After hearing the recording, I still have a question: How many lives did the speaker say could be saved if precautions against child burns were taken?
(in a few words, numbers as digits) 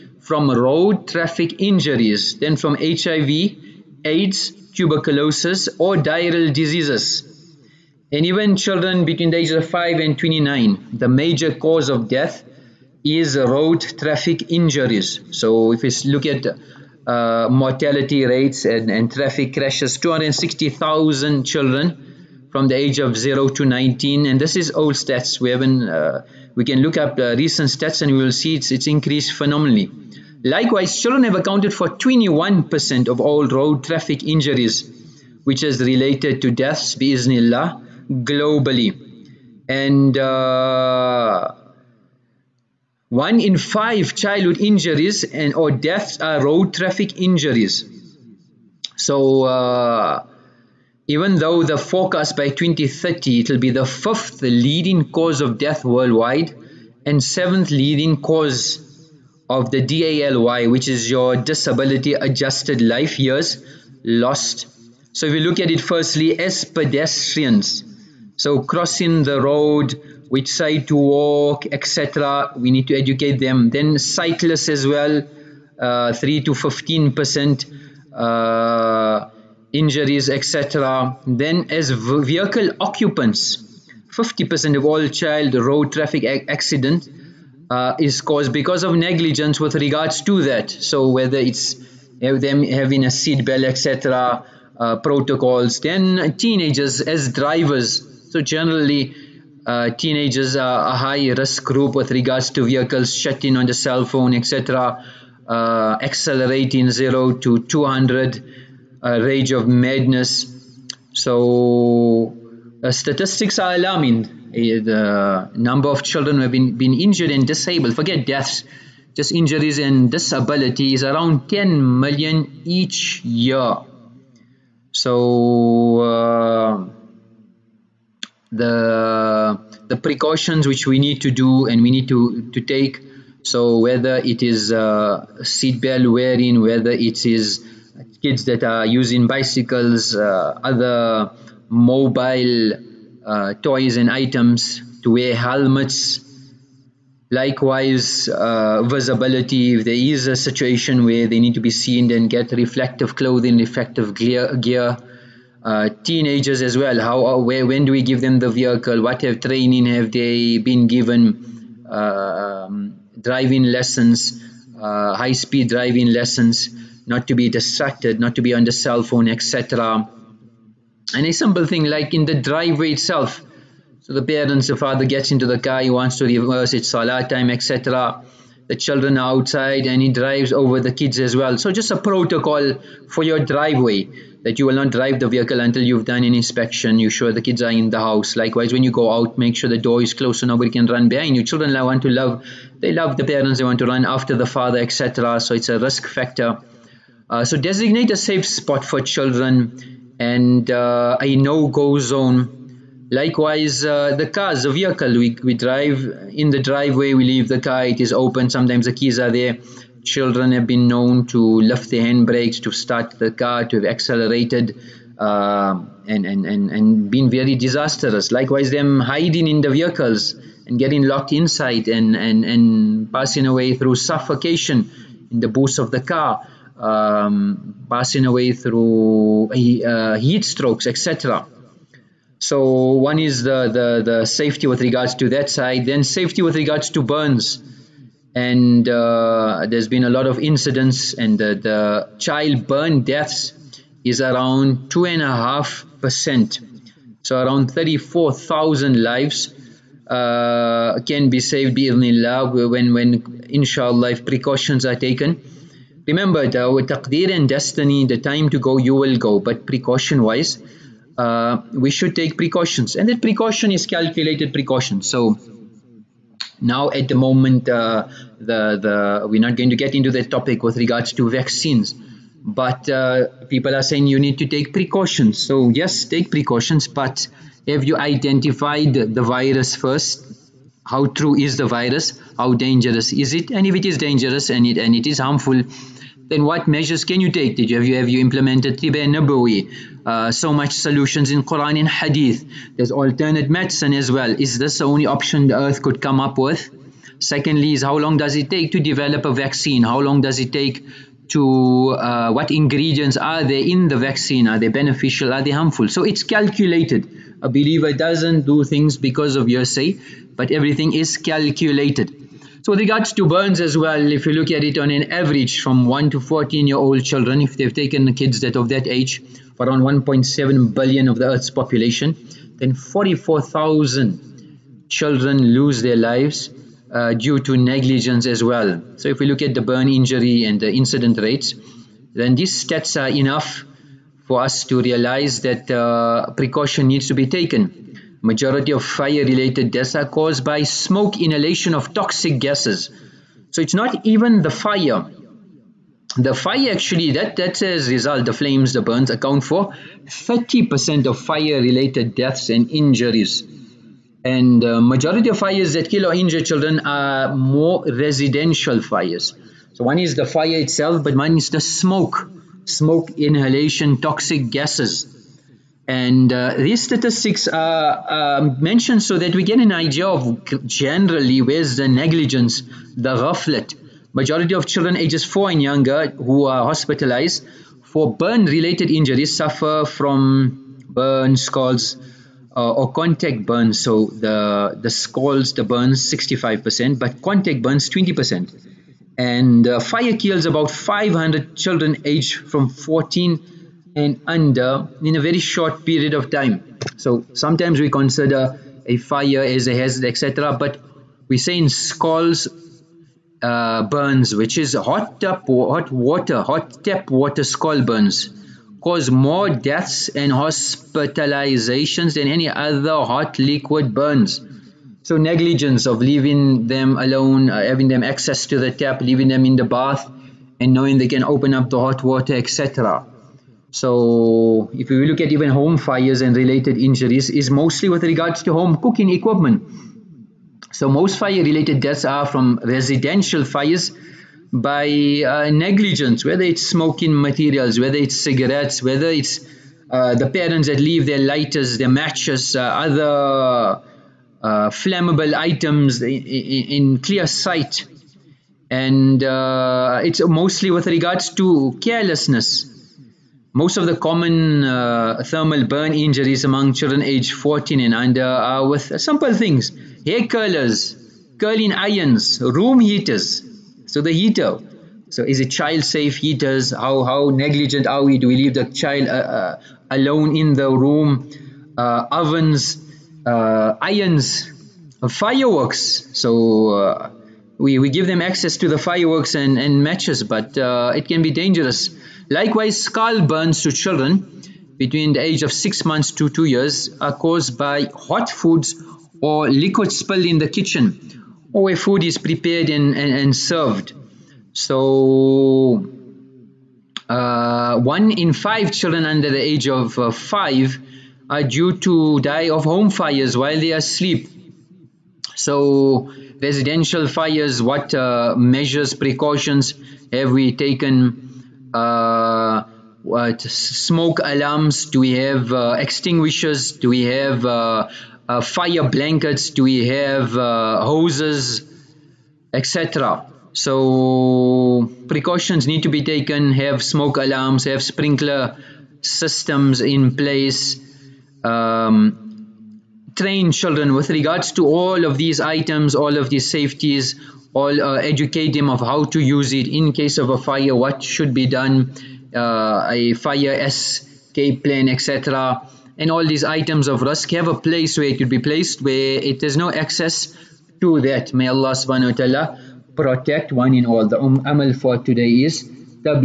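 34,000.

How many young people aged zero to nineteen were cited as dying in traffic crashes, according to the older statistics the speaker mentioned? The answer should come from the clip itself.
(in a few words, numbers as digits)
260,000.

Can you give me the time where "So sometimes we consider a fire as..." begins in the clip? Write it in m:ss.
6:36.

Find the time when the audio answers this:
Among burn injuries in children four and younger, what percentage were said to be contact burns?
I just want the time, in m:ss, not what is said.
6:27.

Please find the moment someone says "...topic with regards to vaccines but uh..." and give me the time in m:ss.
4:30.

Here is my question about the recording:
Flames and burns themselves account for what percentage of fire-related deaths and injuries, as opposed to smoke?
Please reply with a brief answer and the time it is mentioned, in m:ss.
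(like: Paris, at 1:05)
30%, at 5:50.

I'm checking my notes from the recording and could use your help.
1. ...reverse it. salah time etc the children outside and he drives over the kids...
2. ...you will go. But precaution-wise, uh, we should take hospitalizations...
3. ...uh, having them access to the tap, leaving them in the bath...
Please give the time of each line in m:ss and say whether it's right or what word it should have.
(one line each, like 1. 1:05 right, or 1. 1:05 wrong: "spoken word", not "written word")
1. 2:56 right
2. 4:18 wrong: "precautions", not "hospitalizations"
3. 6:57 right.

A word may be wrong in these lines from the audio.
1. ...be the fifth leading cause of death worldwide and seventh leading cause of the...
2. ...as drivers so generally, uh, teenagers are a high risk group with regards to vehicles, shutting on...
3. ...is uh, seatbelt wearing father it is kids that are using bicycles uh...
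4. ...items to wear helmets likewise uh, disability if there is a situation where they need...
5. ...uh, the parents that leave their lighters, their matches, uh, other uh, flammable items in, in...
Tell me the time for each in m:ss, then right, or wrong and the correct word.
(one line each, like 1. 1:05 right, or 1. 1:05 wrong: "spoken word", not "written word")
1. 0:53 right
2. 1:37 right
3. 2:14 wrong: "whether", not "father"
4. 2:24 wrong: "visibility", not "disability"
5. 7:19 right.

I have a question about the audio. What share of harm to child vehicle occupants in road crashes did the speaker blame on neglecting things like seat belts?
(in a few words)
50 percent.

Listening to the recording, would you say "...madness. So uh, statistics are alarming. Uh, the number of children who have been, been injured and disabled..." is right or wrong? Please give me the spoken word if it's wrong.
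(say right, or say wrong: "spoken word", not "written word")
right.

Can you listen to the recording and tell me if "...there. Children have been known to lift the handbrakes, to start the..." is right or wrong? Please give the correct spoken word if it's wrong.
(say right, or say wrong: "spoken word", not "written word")
right.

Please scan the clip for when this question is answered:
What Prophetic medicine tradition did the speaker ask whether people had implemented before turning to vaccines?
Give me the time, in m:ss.
4:48.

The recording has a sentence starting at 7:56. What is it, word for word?
So, we, we give them access to the fireworks and, and matches, but uh, it can be dangerous.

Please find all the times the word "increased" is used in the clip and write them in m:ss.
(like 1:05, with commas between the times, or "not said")
0:28.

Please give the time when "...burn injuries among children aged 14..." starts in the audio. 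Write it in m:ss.
7:35.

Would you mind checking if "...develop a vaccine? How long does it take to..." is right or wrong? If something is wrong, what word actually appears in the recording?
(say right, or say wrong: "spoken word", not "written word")
right.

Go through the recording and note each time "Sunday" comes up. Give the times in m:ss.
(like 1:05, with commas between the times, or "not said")
not said.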